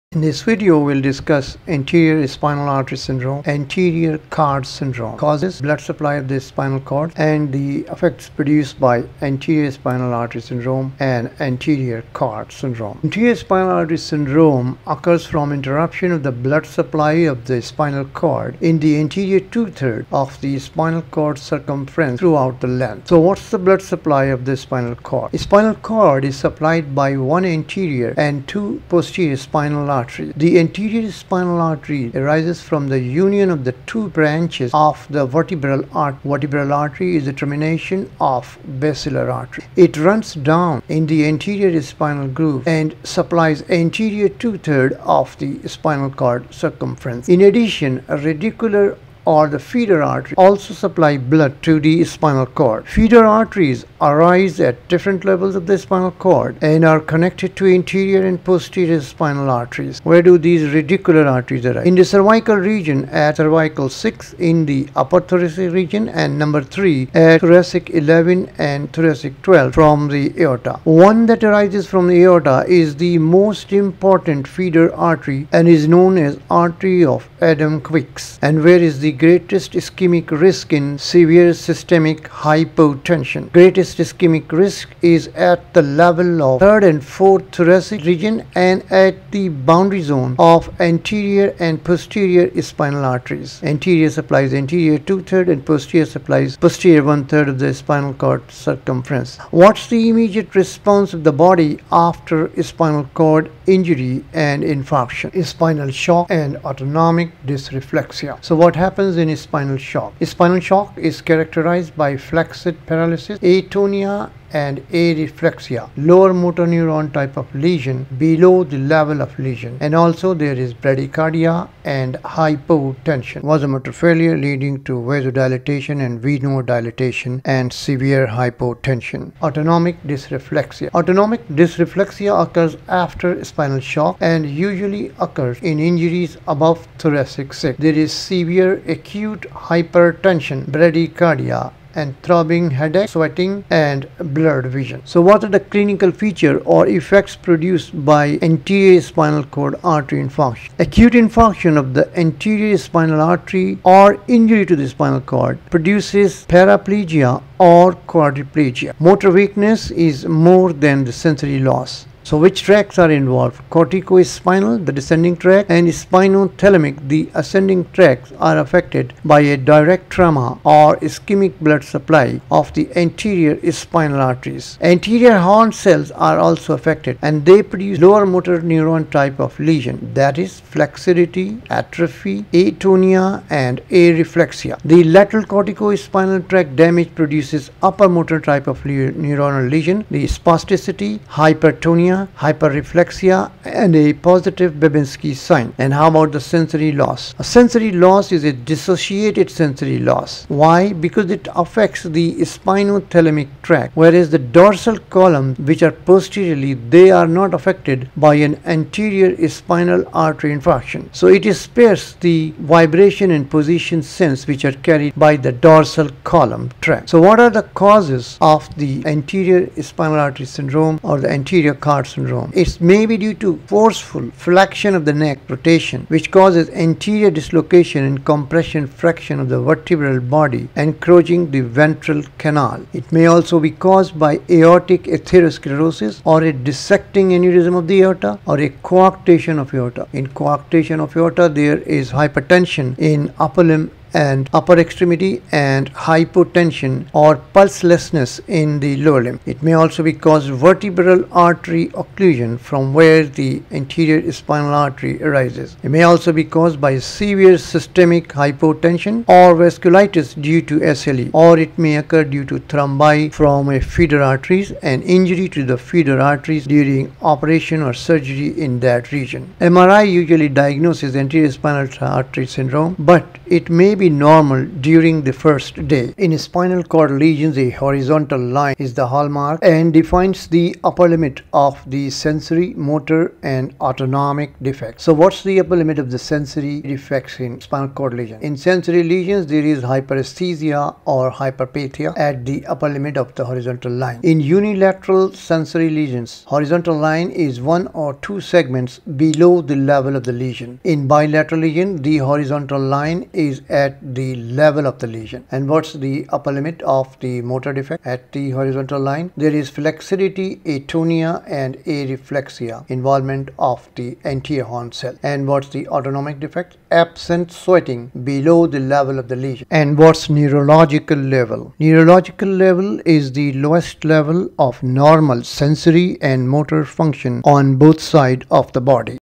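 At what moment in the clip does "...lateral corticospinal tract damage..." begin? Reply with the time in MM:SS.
03:05.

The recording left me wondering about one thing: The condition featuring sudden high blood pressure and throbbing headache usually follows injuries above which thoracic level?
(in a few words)
thoracic 6.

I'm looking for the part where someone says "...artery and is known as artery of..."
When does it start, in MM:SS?
01:14.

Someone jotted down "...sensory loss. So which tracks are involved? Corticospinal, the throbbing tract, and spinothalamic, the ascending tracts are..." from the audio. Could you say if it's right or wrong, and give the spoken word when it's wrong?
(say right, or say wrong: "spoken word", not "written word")
wrong: "descending", not "throbbing".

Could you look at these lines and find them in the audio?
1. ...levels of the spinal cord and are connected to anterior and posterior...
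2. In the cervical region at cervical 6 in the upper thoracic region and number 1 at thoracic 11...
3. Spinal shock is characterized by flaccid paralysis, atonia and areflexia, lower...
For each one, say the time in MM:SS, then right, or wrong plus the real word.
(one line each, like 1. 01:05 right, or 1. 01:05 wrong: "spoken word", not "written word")
1. 00:55 right
2. 01:01 wrong: "3", not "1"
3. 01:50 right.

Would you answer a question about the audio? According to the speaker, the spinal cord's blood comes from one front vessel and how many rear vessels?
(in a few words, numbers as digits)
2.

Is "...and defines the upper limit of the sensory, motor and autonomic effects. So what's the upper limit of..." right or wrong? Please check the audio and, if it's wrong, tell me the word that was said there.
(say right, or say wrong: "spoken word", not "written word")
wrong: "defects", not "effects".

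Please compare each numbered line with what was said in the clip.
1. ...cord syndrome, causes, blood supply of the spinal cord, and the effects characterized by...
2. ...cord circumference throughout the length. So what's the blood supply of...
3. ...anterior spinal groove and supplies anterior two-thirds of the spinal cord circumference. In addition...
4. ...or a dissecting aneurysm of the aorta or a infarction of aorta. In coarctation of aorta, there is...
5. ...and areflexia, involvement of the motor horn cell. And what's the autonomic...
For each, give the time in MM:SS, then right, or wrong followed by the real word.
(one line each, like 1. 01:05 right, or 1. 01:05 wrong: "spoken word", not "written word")
1. 00:04 wrong: "produced", not "characterized"
2. 00:21 right
3. 00:41 right
4. 03:56 wrong: "coarctation", not "infarction"
5. 05:11 wrong: "anterior", not "motor".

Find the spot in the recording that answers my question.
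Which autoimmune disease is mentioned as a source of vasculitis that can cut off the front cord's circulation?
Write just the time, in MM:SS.
04:20.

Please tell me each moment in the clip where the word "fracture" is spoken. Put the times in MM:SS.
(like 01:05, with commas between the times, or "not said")
03:48.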